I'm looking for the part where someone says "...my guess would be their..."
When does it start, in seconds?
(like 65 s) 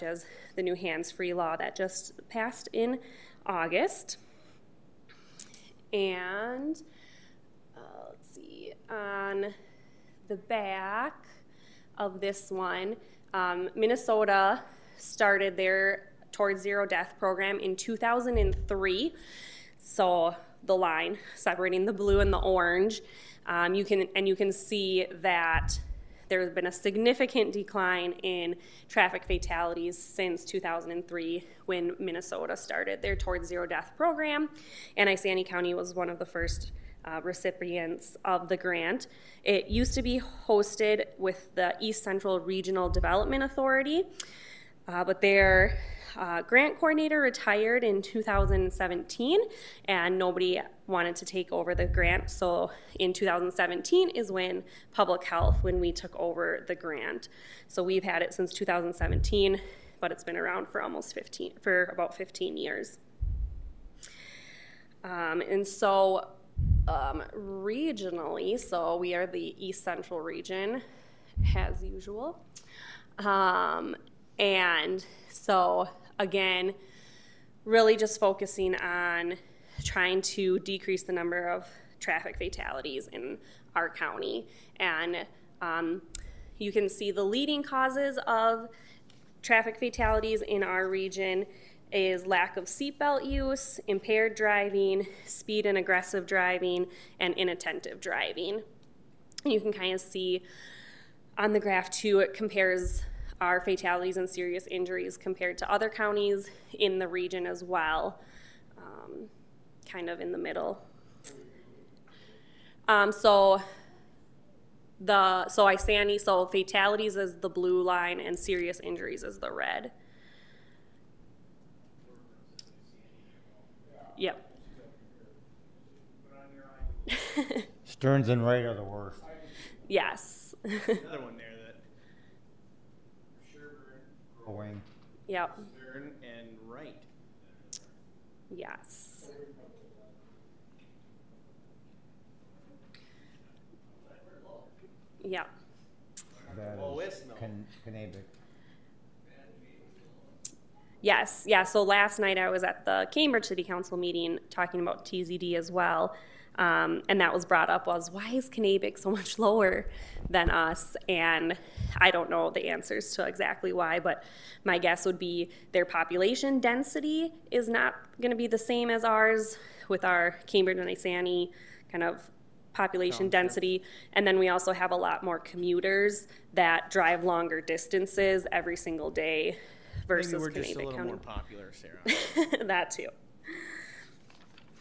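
164 s.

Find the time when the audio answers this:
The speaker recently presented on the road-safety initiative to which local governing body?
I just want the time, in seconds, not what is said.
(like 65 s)
153 s.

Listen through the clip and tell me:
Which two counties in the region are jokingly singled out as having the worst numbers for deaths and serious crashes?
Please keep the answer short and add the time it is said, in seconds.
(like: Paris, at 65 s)
Stearns and Wright, at 127 s.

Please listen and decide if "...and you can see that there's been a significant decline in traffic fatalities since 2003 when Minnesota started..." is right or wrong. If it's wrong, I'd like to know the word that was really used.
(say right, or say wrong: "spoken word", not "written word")
right.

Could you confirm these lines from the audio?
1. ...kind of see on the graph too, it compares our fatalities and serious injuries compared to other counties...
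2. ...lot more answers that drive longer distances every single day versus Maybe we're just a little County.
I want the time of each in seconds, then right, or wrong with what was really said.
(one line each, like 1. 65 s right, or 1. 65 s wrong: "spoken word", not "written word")
1. 99 s right
2. 174 s wrong: "commuters", not "answers".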